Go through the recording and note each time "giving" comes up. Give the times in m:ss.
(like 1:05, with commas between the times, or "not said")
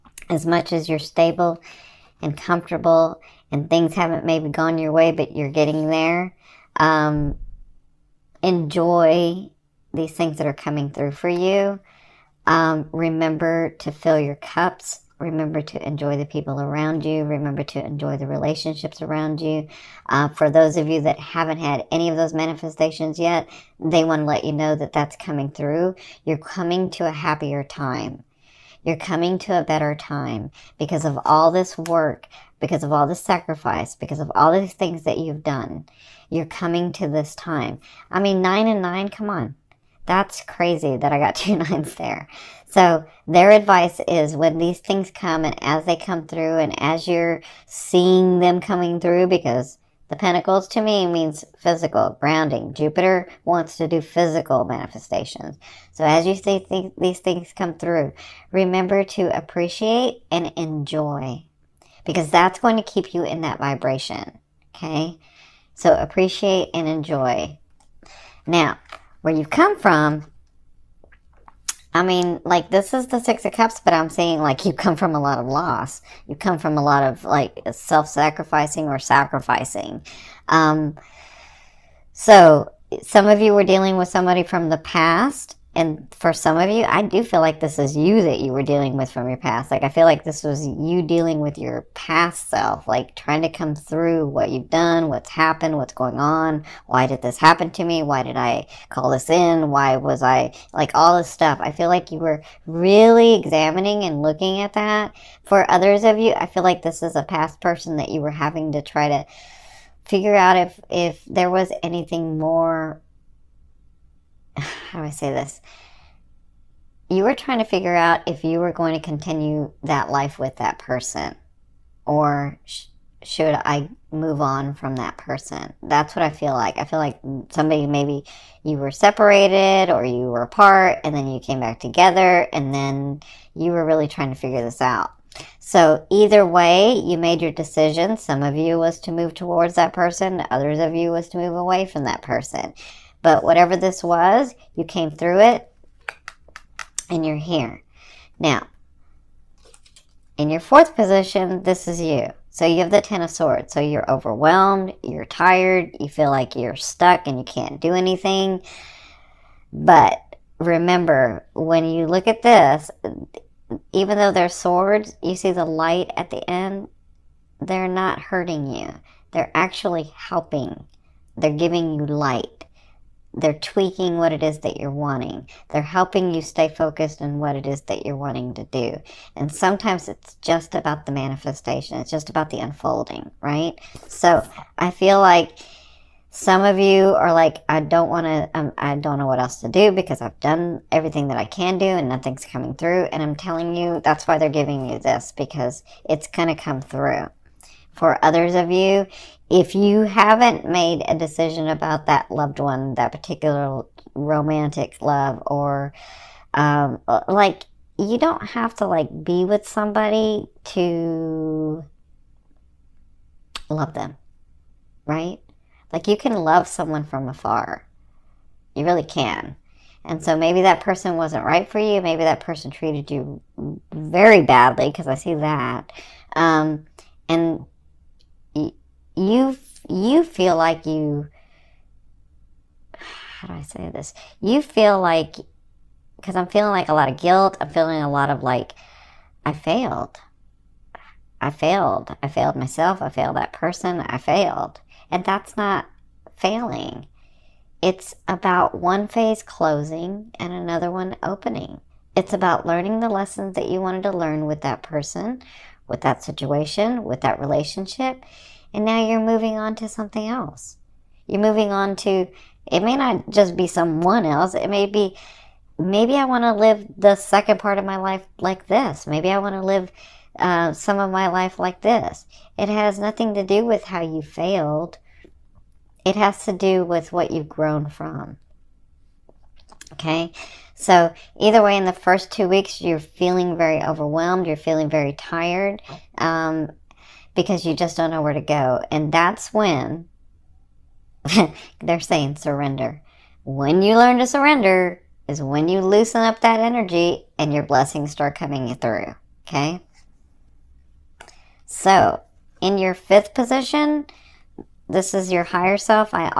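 2:51, 3:14.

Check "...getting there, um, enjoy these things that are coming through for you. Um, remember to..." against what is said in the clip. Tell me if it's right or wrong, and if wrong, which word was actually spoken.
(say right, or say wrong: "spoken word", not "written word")
right.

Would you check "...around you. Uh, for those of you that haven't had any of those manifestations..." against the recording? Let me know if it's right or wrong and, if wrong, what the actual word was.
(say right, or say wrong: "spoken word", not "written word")
right.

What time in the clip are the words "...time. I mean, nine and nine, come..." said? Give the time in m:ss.
0:37.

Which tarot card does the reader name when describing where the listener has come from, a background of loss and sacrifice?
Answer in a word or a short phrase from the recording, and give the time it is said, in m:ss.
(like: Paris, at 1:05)
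Six of Cups, at 1:13.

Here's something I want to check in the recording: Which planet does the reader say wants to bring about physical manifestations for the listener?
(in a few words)
Jupiter.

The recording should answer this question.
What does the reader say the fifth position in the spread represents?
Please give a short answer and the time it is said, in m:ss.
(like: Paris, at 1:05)
higher self, at 5:05.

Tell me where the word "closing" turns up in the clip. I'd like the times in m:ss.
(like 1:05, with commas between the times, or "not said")
4:09.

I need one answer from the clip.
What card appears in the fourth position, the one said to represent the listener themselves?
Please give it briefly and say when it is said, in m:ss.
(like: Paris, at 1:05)
Ten of Swords, at 2:32.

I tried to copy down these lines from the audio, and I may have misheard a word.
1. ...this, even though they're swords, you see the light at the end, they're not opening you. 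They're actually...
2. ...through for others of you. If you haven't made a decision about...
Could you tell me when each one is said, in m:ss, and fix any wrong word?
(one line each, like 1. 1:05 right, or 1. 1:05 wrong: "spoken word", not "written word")
1. 2:42 wrong: "hurting", not "opening"
2. 3:16 right.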